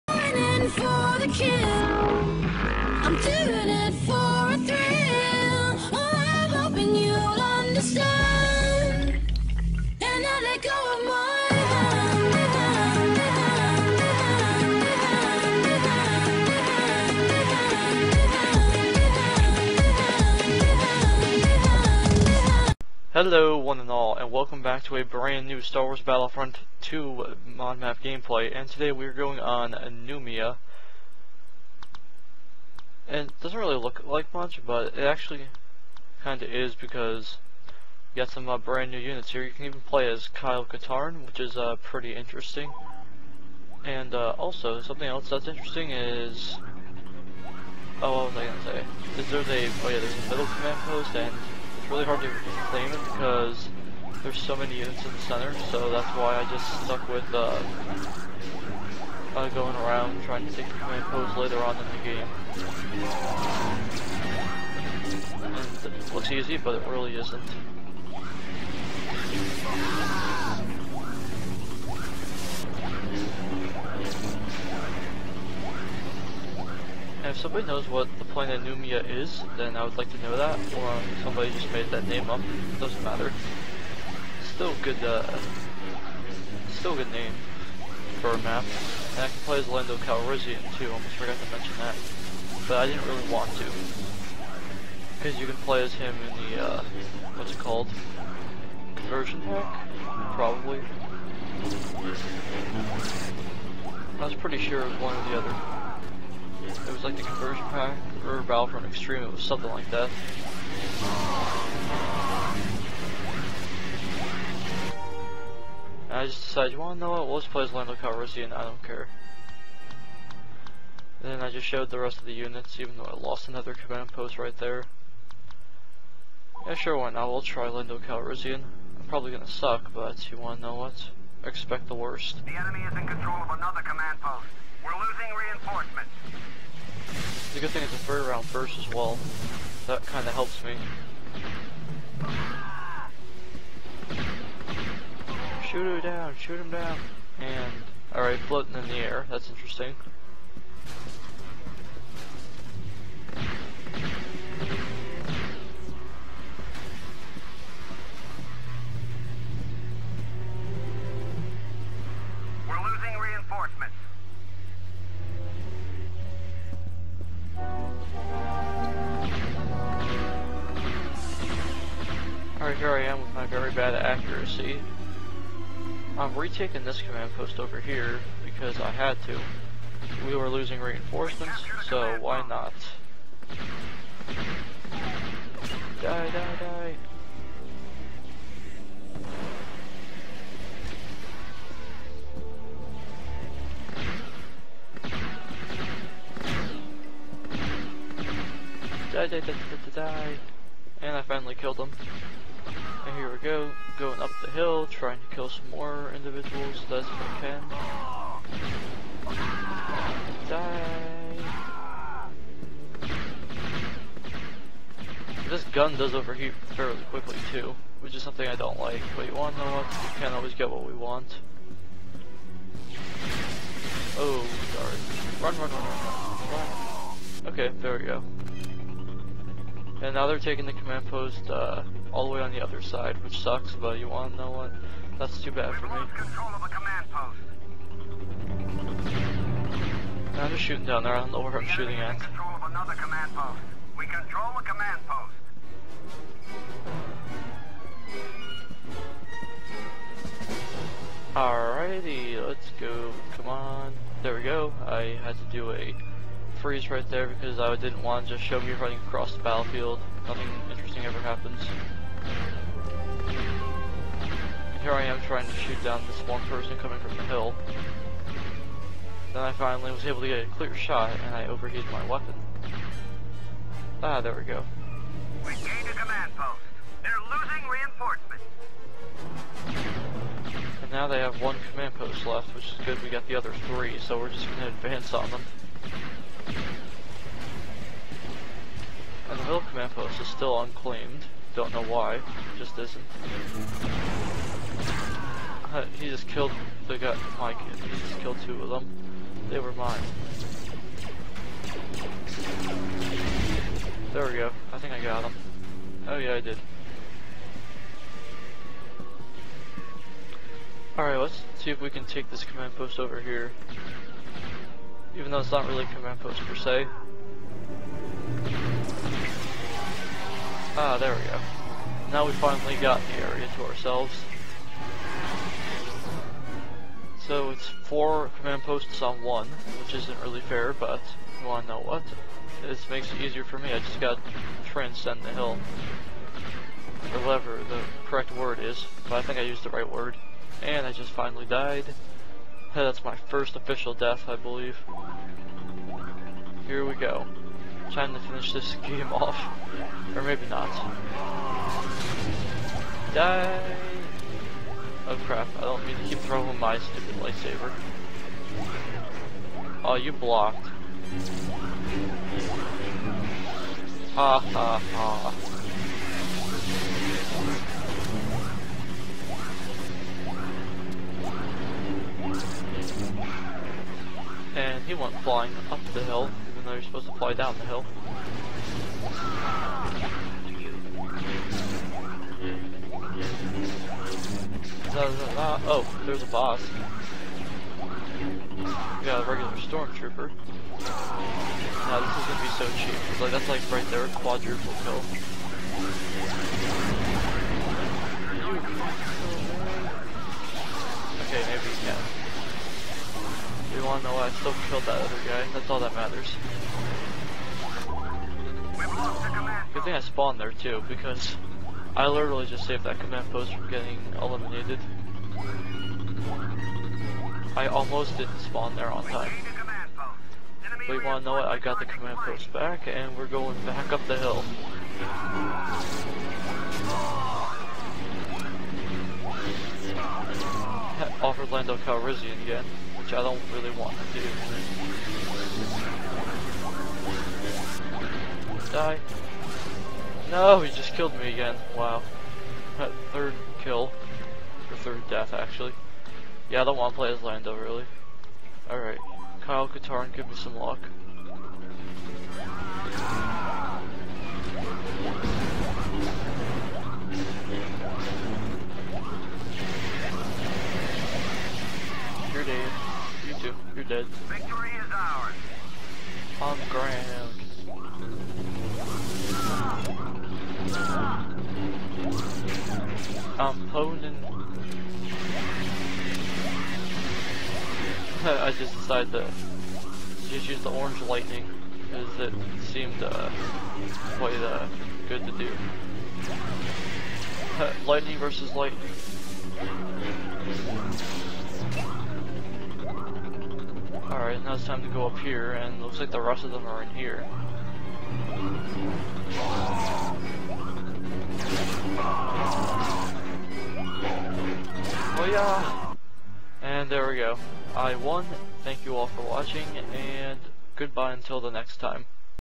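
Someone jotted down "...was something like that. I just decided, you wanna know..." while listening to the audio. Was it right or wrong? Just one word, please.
right.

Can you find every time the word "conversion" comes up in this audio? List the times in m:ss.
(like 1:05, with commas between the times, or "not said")
1:38, 1:47.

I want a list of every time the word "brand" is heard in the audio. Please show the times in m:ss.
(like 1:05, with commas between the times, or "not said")
0:25, 0:38.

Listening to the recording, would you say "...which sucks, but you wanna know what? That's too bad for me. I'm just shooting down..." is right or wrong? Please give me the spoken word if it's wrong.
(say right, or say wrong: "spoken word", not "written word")
right.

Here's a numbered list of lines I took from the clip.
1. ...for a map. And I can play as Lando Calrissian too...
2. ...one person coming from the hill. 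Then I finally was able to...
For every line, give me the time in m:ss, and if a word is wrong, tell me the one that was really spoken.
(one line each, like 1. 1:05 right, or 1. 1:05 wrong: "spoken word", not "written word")
1. 1:28 right
2. 4:26 right.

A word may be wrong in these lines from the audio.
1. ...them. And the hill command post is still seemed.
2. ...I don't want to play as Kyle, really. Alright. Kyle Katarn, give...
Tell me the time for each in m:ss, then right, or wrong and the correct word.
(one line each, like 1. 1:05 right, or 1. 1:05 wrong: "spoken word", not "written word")
1. 4:45 wrong: "unclaimed", not "seemed"
2. 7:26 wrong: "Lando", not "Kyle".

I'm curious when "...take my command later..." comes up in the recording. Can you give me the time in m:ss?
1:00.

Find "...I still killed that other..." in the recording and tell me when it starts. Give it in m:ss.
6:44.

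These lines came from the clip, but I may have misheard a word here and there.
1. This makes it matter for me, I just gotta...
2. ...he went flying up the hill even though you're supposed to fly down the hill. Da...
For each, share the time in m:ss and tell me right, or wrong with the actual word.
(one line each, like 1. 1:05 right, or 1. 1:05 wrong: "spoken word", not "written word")
1. 5:32 wrong: "easier", not "matter"
2. 6:14 right.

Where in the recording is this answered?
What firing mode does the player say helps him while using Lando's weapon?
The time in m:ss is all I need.
2:17.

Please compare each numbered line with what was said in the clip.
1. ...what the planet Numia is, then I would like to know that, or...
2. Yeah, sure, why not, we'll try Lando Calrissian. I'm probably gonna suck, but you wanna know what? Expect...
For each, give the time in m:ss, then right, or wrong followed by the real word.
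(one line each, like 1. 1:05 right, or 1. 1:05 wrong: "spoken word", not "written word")
1. 1:17 right
2. 2:06 right.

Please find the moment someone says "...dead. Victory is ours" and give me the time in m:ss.
7:44.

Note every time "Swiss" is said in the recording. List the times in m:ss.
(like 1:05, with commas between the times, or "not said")
not said.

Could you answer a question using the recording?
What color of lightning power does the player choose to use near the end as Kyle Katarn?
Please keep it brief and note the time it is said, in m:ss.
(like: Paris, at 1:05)
Orange, at 8:00.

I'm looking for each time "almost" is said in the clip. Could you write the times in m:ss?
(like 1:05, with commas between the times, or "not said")
1:30, 6:57.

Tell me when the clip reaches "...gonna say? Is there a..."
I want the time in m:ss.
0:48.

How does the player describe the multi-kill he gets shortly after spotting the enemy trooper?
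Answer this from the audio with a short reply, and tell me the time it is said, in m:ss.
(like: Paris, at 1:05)
Quadruple kill, at 6:34.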